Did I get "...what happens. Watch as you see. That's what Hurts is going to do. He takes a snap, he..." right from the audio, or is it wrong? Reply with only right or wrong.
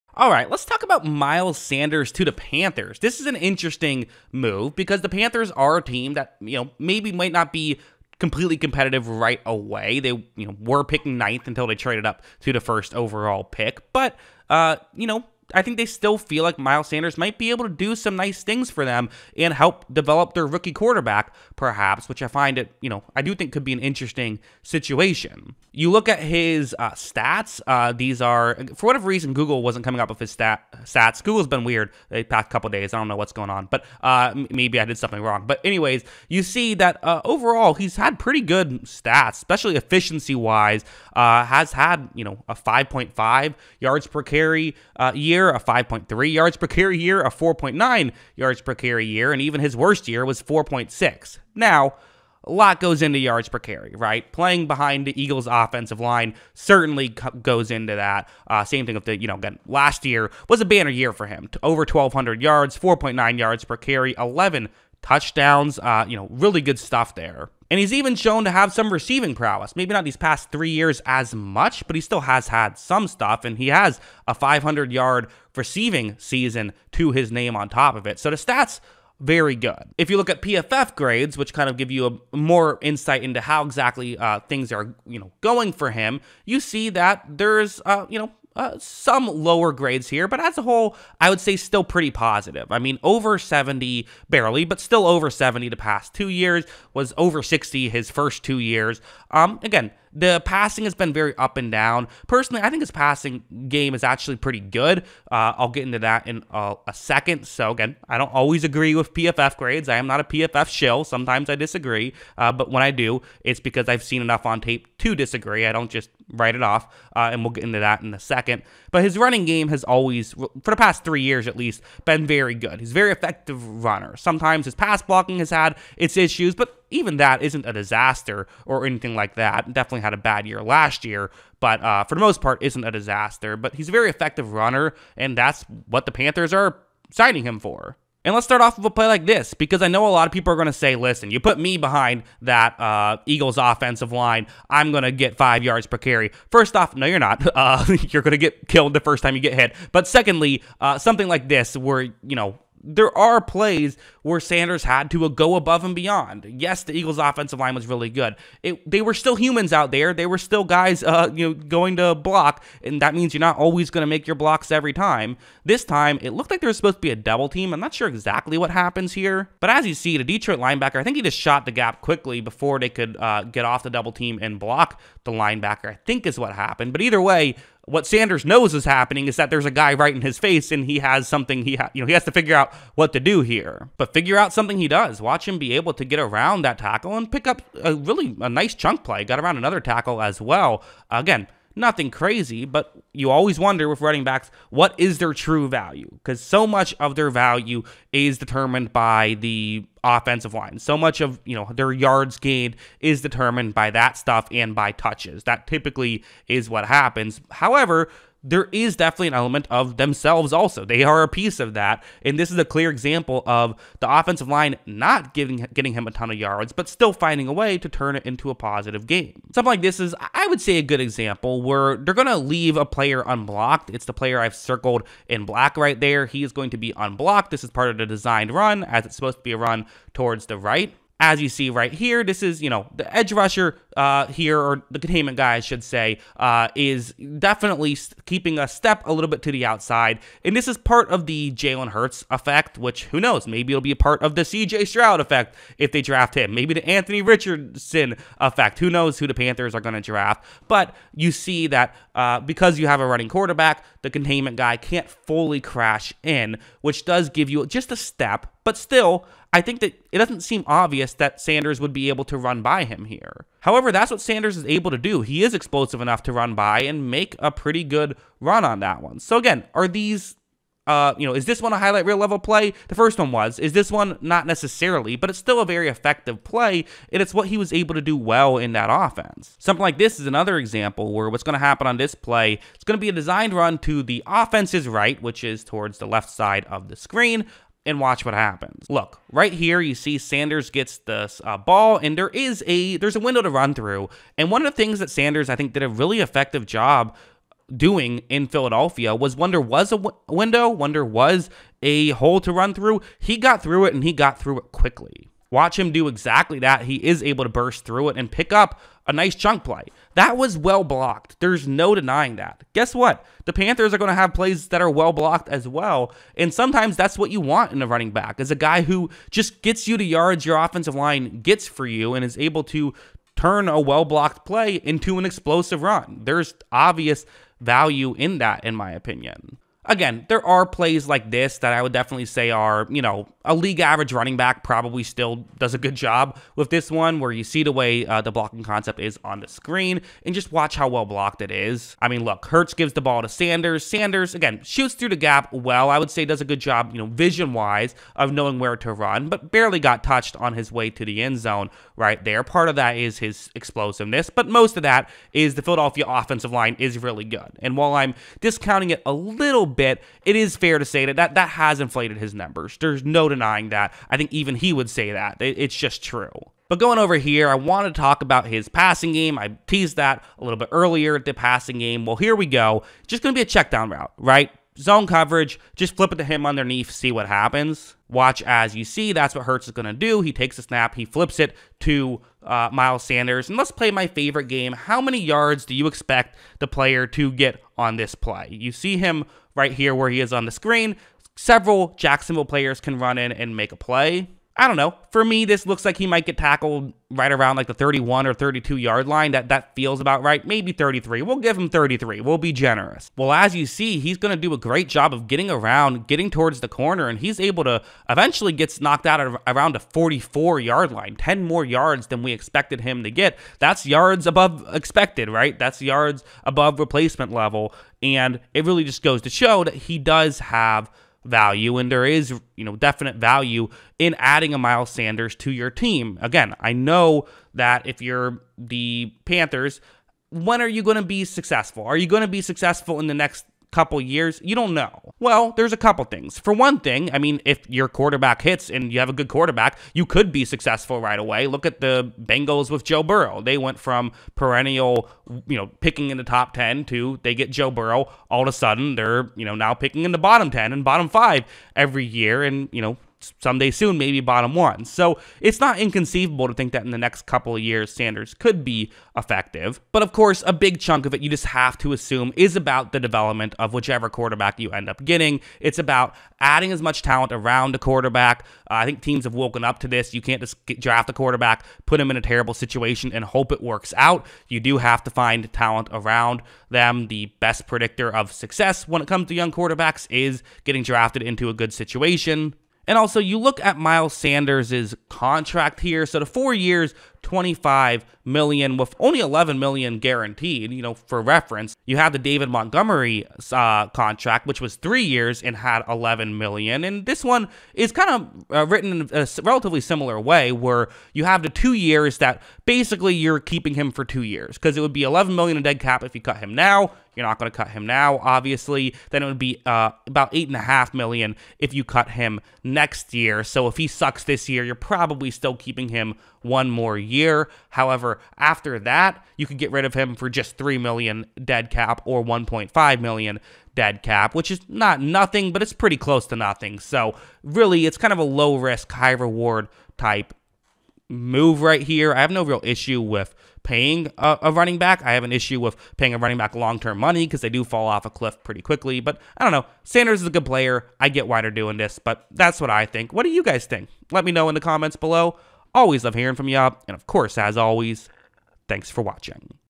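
right.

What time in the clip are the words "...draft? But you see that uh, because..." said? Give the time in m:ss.
4:10.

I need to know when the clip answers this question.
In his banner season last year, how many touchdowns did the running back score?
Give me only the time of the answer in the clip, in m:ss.
1:04.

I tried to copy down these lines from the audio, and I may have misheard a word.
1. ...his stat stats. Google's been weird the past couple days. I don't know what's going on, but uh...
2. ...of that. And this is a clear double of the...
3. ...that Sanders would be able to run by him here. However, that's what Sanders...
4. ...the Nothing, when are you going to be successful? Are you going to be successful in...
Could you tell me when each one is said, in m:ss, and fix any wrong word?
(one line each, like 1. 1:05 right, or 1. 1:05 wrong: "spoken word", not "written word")
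1. 0:30 right
2. 3:31 wrong: "example", not "double"
3. 4:21 right
4. 7:08 wrong: "Panthers", not "Nothing".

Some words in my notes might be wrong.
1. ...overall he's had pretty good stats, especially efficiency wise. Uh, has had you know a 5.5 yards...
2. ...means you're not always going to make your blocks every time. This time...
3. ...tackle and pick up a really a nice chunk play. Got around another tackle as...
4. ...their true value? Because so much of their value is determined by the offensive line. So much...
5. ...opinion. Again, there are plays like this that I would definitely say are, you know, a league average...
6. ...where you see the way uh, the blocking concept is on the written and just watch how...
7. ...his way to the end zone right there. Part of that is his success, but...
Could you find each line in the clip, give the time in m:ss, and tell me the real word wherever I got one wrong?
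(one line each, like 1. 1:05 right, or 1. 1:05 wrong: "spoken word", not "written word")
1. 0:37 right
2. 2:43 right
3. 3:06 right
4. 3:15 right
5. 5:28 right
6. 5:37 wrong: "screen", not "written"
7. 5:50 wrong: "explosiveness", not "success".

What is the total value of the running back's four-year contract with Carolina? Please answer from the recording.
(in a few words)
$25 million.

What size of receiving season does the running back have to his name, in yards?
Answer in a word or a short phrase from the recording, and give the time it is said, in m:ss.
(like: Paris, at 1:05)
500, at 1:14.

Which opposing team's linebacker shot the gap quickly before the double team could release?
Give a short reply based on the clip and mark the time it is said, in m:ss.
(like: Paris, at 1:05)
Detroit, at 2:50.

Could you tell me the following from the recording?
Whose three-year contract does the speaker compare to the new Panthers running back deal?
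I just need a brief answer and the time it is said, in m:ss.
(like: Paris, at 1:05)
David Montgomery, at 8:12.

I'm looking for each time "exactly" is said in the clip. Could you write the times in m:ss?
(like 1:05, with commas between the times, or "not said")
1:23, 2:48, 5:06.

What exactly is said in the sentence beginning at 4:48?
Look, right here you see Sanders gets this uh, ball and there is a there's a window to run through.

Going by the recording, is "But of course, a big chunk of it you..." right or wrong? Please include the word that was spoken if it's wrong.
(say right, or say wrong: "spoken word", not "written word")
right.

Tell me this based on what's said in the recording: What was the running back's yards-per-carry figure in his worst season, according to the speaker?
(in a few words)
4.6.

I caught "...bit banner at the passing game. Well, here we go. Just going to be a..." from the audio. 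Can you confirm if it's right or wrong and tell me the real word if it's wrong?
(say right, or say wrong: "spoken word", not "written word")
wrong: "earlier", not "banner".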